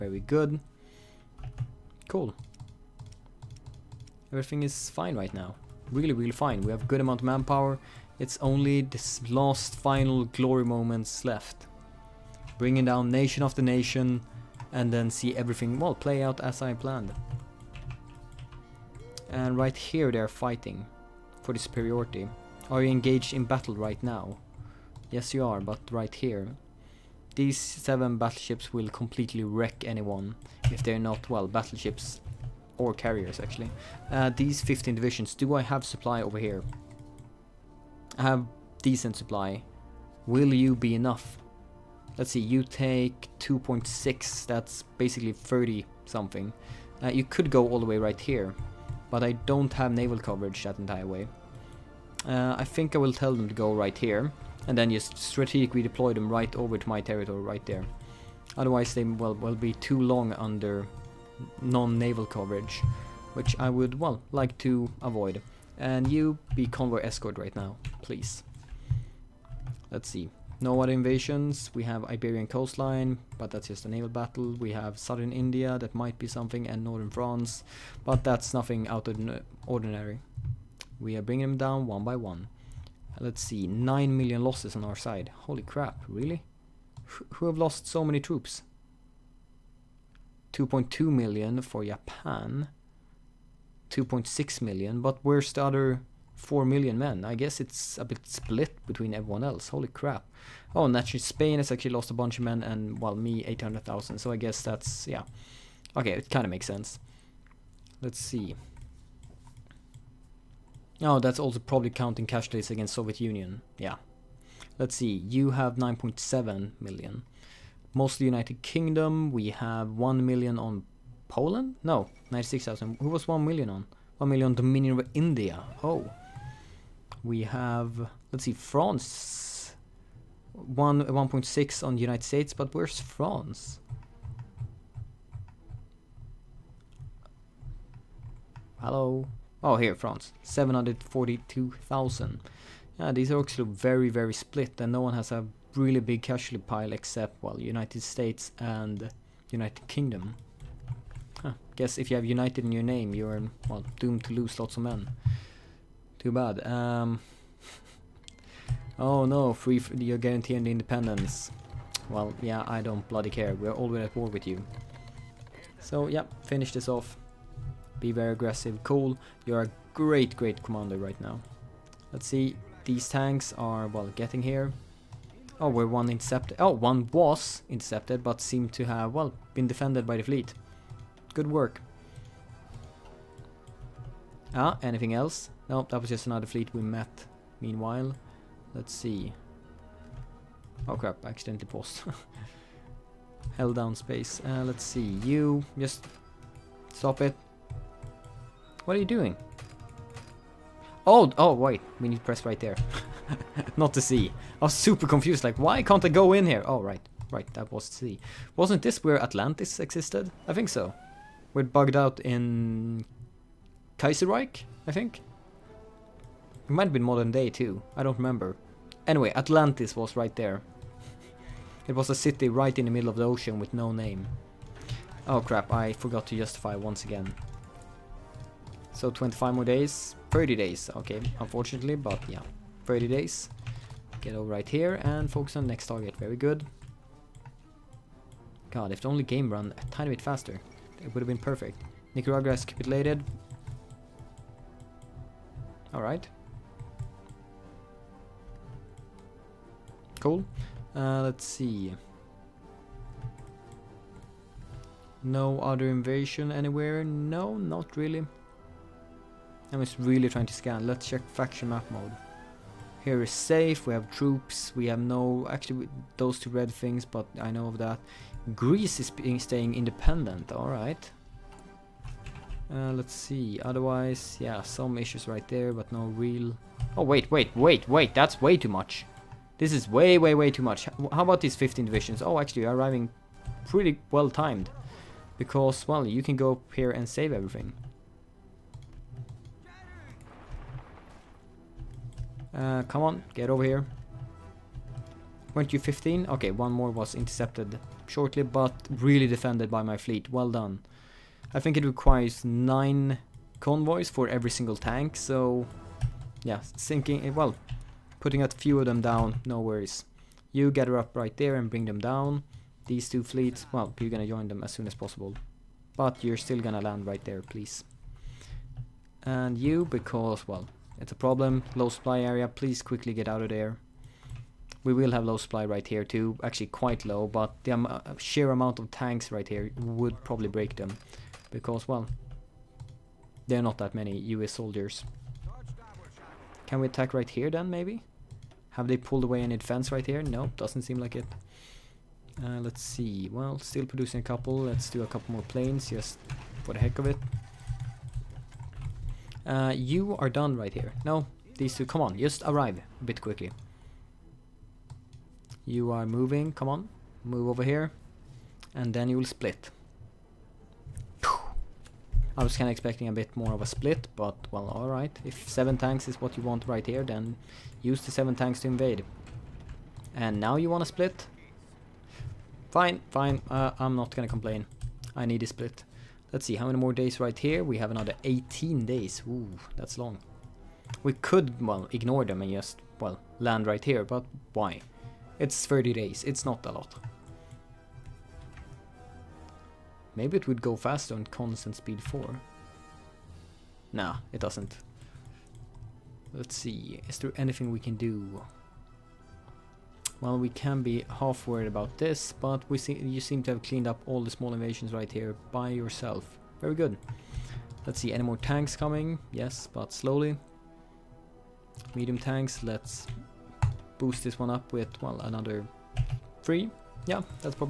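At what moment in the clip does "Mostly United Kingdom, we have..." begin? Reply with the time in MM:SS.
01:57.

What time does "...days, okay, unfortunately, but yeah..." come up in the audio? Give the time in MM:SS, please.
03:50.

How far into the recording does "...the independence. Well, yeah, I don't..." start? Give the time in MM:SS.
02:40.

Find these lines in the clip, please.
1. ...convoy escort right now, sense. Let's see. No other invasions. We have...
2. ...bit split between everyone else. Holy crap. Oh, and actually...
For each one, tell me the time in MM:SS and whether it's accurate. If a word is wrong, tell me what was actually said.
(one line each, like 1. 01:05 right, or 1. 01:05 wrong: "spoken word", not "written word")
1. 01:06 wrong: "please", not "sense"
2. 01:38 right.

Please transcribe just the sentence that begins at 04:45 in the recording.
Because, well, you can go up here and save everything.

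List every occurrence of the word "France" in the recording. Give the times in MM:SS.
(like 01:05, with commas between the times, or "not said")
01:17, 02:08, 02:12, 02:19.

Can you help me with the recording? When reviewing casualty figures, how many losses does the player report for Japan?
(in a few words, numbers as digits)
2.2 million.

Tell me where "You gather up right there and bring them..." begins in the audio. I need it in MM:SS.
05:10.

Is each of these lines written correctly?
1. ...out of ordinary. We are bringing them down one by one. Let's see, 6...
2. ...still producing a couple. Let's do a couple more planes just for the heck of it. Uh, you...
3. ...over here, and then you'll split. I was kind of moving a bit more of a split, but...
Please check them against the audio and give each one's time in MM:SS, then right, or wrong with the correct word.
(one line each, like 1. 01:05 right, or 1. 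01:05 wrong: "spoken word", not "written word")
1. 01:18 wrong: "9", not "6"
2. 05:43 right
3. 05:57 wrong: "expecting", not "moving".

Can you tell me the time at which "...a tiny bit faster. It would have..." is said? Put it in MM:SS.
03:59.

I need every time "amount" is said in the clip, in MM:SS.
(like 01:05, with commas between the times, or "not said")
00:06, 05:28.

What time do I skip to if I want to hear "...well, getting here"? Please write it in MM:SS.
02:53.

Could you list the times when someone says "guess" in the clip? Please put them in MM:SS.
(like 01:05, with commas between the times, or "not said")
01:37, 01:44, 02:31.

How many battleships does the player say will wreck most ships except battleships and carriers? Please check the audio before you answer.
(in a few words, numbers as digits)
7.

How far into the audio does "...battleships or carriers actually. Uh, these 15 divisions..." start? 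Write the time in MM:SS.
00:31.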